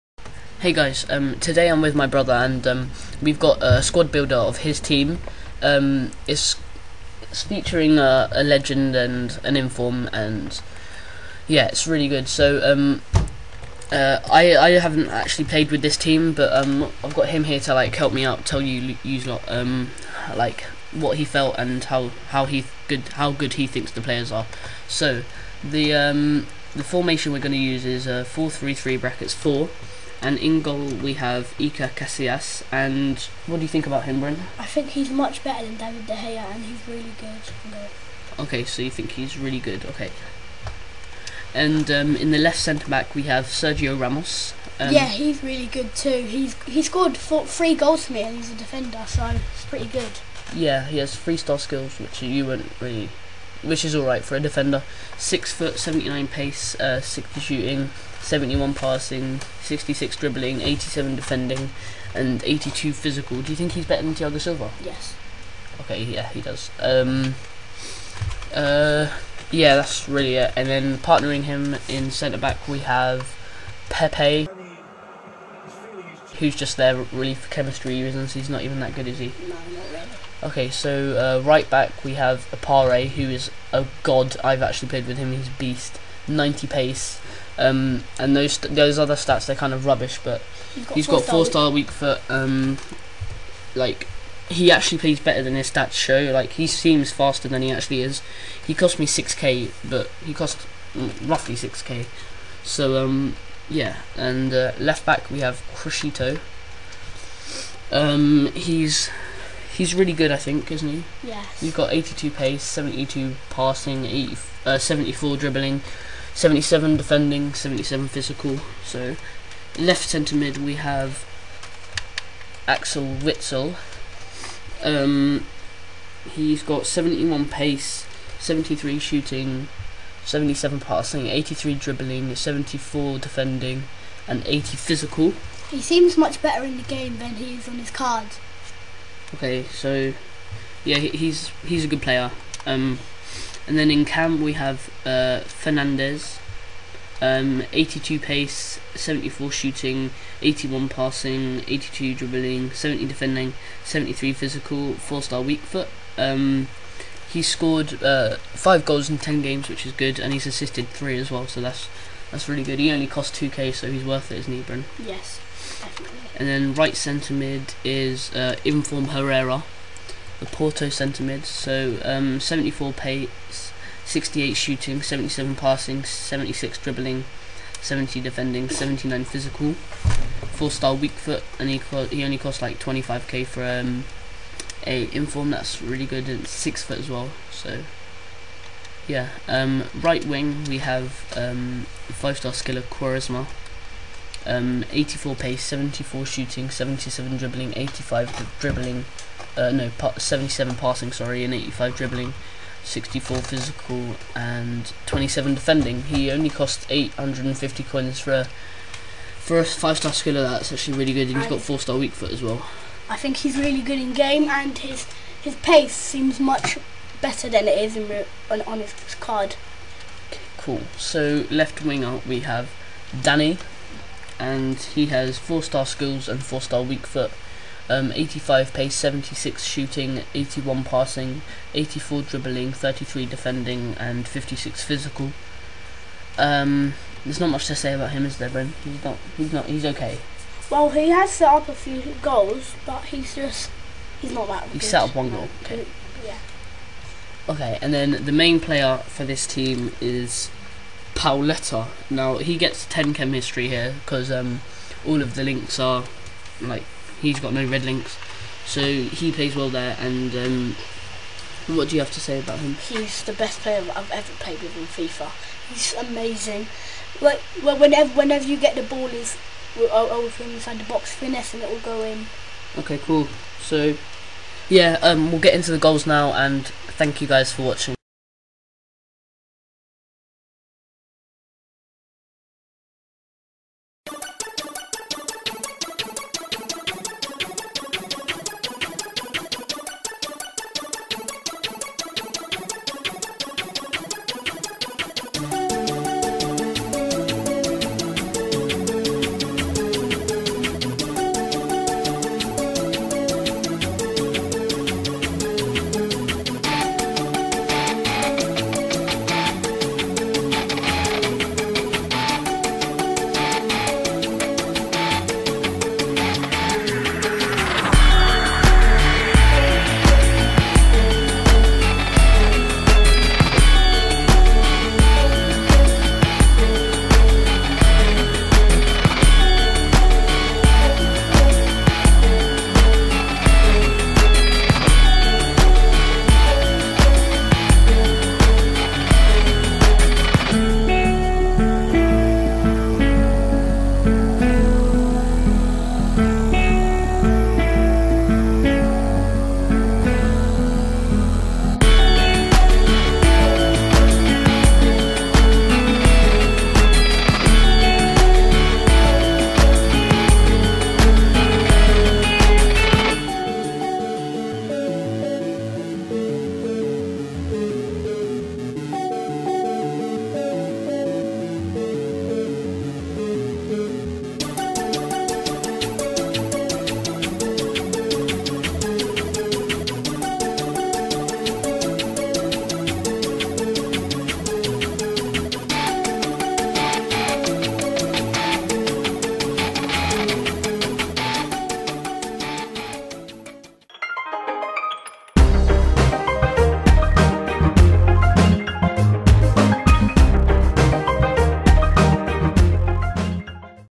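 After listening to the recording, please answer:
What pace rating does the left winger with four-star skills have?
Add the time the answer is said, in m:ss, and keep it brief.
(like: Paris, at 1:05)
85, at 3:48.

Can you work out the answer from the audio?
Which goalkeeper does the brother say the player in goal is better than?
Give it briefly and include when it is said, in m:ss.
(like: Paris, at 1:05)
David De Gea, at 0:35.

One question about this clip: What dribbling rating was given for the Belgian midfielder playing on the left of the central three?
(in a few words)
83.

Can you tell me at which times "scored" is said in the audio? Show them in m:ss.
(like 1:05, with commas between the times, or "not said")
0:46, 2:37.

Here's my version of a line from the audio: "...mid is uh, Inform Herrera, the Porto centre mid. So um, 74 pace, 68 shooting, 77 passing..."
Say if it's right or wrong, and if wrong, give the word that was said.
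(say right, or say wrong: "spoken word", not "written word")
right.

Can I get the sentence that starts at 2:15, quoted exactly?
He seems much better in the game than he is on his cards.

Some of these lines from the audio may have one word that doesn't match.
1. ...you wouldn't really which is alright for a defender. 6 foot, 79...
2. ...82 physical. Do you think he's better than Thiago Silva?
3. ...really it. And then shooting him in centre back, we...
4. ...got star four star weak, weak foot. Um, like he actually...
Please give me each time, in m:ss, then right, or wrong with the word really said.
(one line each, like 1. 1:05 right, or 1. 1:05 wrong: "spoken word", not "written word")
1. 0:52 right
2. 1:02 right
3. 1:10 wrong: "partnering", not "shooting"
4. 1:31 right.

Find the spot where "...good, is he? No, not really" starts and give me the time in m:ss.
1:18.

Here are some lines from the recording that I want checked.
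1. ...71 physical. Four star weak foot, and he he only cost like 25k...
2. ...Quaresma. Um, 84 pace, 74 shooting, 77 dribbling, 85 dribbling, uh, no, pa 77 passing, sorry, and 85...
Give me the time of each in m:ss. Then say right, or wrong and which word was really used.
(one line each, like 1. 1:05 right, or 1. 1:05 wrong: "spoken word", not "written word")
1. 2:58 wrong: "79", not "71"
2. 3:12 right.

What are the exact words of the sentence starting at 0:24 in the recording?
So the the formation we're going to use is uh, four three three brackets four.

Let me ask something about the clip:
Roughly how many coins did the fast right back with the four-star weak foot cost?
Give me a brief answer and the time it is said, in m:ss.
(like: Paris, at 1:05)
6k, at 1:41.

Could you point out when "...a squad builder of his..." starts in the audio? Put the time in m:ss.
0:03.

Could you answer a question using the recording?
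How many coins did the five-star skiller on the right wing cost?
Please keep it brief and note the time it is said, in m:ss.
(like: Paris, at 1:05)
850, at 3:26.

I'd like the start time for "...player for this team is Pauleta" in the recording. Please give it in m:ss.
4:08.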